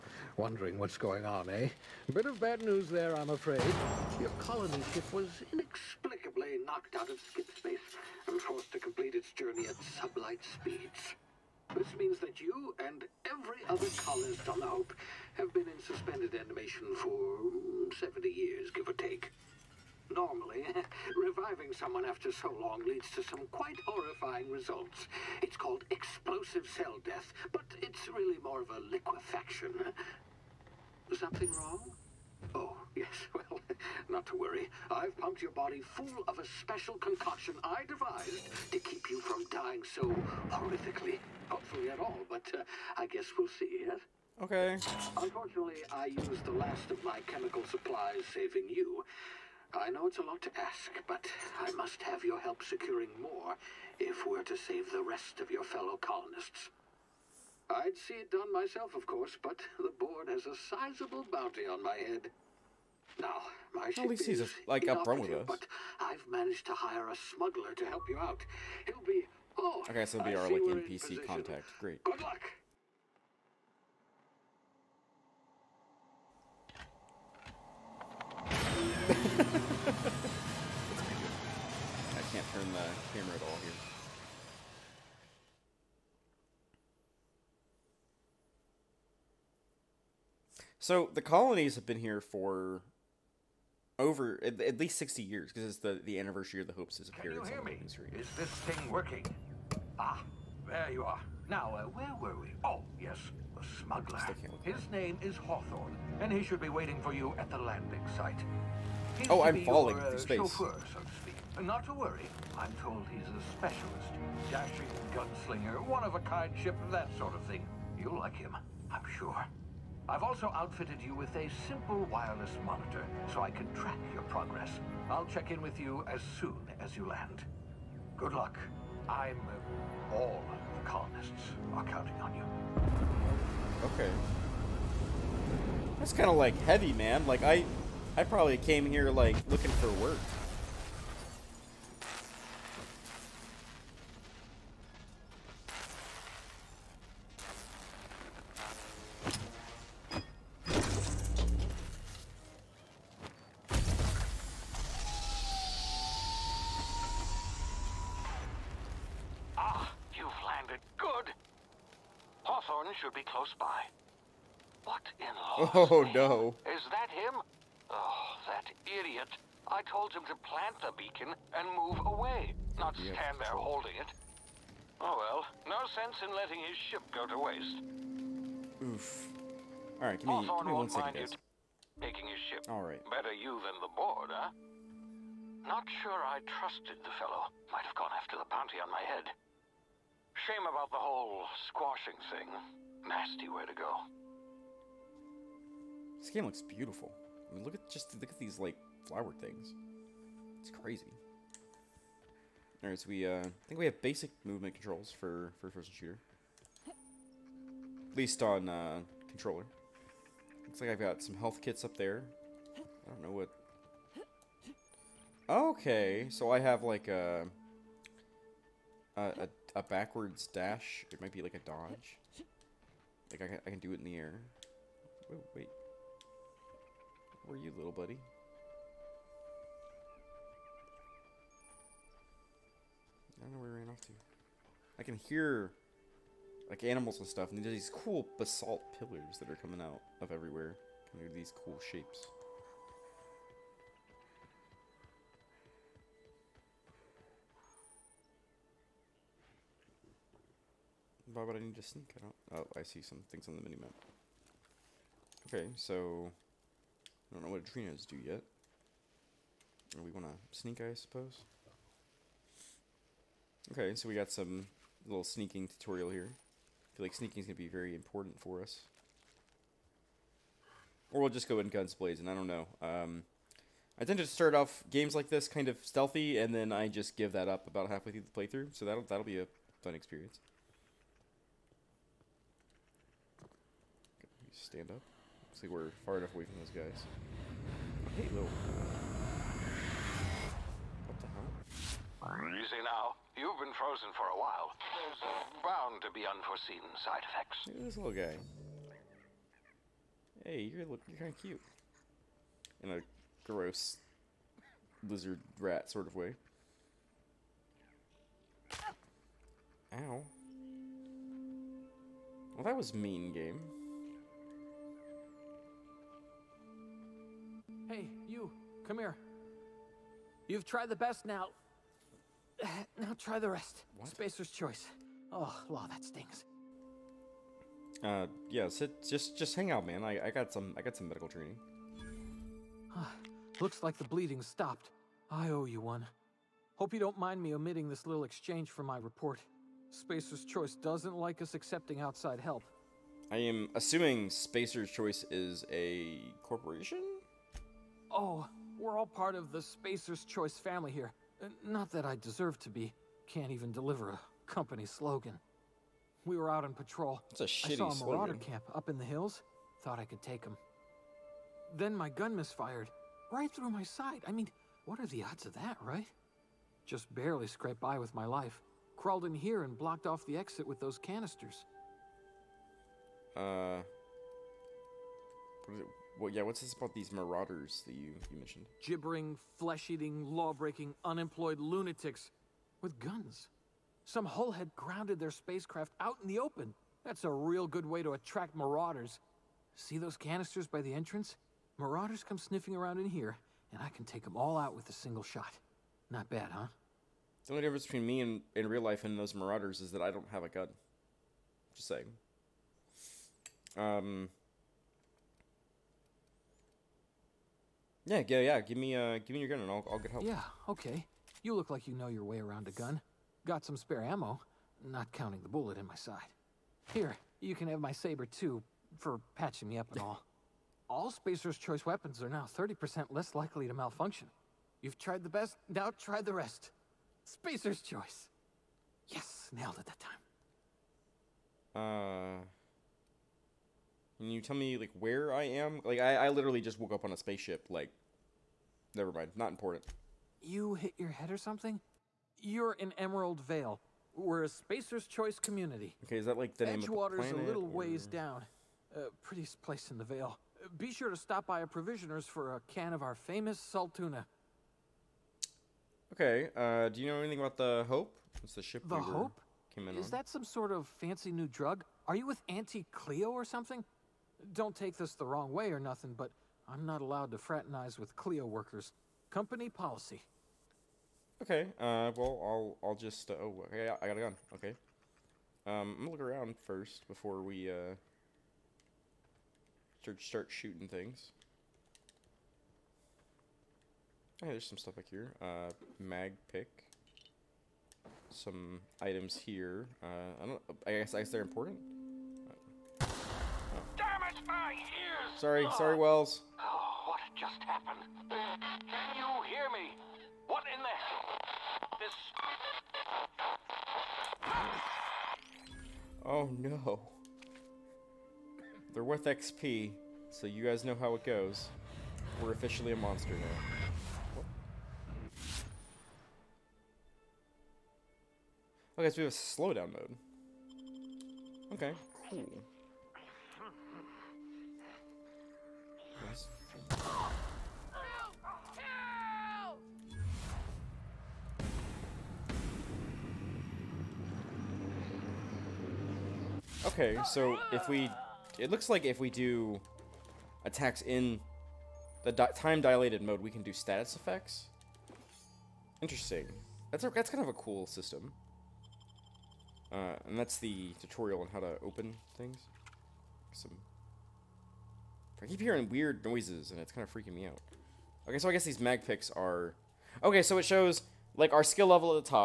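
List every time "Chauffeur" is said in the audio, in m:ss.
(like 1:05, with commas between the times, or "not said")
1:50.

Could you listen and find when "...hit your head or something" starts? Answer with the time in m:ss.
7:20.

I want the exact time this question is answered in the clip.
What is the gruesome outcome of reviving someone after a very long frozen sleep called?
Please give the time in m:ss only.
0:25.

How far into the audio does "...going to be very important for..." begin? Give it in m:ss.
4:27.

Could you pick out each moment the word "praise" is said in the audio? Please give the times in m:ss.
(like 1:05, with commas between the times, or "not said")
not said.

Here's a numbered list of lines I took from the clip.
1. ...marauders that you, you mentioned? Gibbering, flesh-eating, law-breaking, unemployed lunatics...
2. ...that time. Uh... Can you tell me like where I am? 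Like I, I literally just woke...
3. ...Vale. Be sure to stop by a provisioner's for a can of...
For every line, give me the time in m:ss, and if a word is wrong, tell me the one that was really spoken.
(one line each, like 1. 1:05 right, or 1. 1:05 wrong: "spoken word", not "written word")
1. 6:17 right
2. 7:09 right
3. 7:30 right.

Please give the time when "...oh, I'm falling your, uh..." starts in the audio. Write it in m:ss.
1:49.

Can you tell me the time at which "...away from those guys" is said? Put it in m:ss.
4:46.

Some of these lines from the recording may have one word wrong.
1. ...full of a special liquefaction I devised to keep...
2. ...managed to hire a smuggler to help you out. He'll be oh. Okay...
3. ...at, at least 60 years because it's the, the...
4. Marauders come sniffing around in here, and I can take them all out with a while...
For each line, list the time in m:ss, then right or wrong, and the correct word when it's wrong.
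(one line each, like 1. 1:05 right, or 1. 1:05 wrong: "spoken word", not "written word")
1. 0:35 wrong: "concoction", not "liquefaction"
2. 1:06 right
3. 1:34 right
4. 6:31 wrong: "single", not "while".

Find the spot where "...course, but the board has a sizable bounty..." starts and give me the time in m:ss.
0:59.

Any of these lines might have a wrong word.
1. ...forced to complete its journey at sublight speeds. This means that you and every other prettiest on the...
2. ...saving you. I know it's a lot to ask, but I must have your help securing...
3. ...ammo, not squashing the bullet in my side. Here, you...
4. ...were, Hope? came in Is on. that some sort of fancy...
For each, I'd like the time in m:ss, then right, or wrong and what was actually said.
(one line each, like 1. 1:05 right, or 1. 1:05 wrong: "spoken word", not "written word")
1. 0:08 wrong: "colonist", not "prettiest"
2. 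0:48 right
3. 6:54 wrong: "counting", not "squashing"
4. 7:39 right.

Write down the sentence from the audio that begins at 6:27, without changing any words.
That's a real good way to attract marauders.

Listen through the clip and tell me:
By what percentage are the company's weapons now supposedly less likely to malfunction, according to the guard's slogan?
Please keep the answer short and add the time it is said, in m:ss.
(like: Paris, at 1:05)
30%, at 7:02.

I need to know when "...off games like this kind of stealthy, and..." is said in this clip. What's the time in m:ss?
4:34.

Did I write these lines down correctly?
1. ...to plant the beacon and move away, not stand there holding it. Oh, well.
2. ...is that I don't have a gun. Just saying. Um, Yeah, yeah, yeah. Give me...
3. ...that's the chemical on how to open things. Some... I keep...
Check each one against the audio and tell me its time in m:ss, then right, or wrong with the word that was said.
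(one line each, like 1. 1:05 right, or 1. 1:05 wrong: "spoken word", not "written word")
1. 2:50 right
2. 6:39 right
3. 9:10 wrong: "tutorial", not "chemical".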